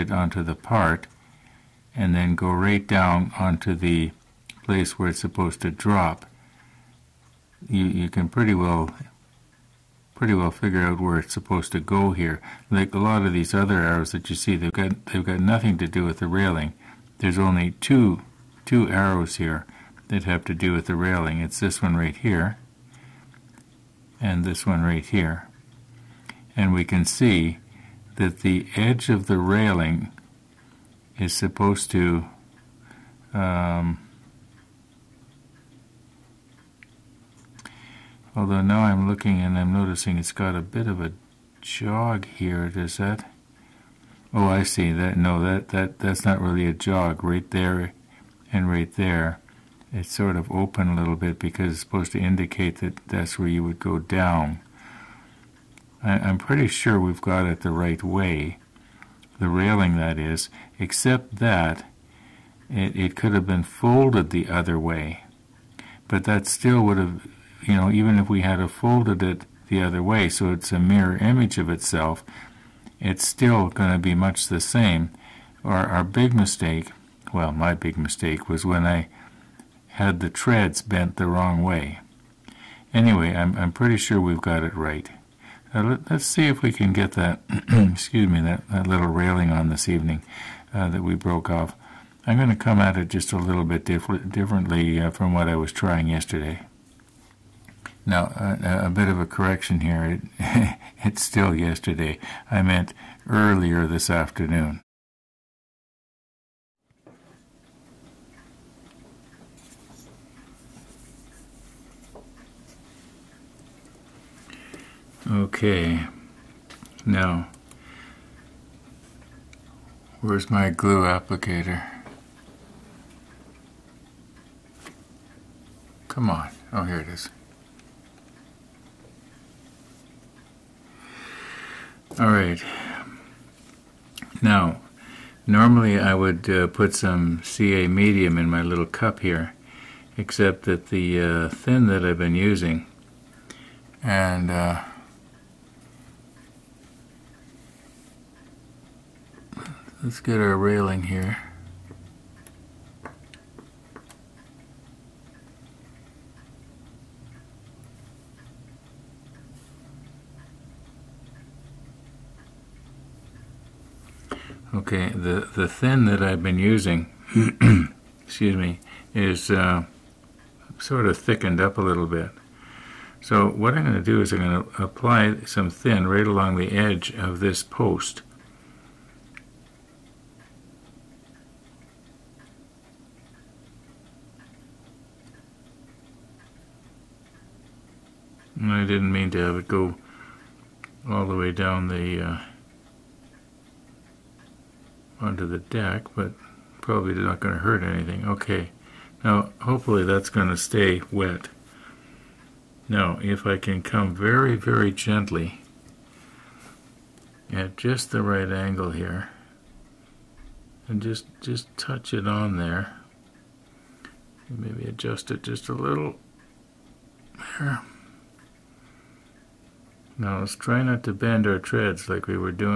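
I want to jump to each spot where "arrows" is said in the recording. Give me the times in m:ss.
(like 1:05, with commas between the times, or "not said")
0:13, 0:18.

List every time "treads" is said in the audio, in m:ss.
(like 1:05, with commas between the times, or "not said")
1:20, 3:41.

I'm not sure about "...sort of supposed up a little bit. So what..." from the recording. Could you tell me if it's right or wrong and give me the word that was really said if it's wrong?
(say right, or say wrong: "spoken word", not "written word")
wrong: "thickened", not "supposed".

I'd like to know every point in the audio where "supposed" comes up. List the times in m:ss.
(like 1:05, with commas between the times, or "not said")
0:05, 0:11, 0:31, 0:51.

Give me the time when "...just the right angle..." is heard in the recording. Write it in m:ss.
3:27.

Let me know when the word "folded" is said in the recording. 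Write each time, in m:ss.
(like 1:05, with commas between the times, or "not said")
1:03, 1:08.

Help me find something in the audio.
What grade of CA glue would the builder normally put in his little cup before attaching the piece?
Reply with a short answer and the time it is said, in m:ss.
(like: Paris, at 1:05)
Medium, at 2:17.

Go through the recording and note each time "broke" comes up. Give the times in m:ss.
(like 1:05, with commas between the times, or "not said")
1:31.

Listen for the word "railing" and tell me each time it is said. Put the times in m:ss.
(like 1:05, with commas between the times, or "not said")
0:16, 0:20, 0:29, 0:59, 1:29, 2:30.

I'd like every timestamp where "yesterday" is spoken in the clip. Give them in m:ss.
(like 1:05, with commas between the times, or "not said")
1:36, 1:41.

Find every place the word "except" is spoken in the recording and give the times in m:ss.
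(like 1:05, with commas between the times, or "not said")
1:00, 2:20.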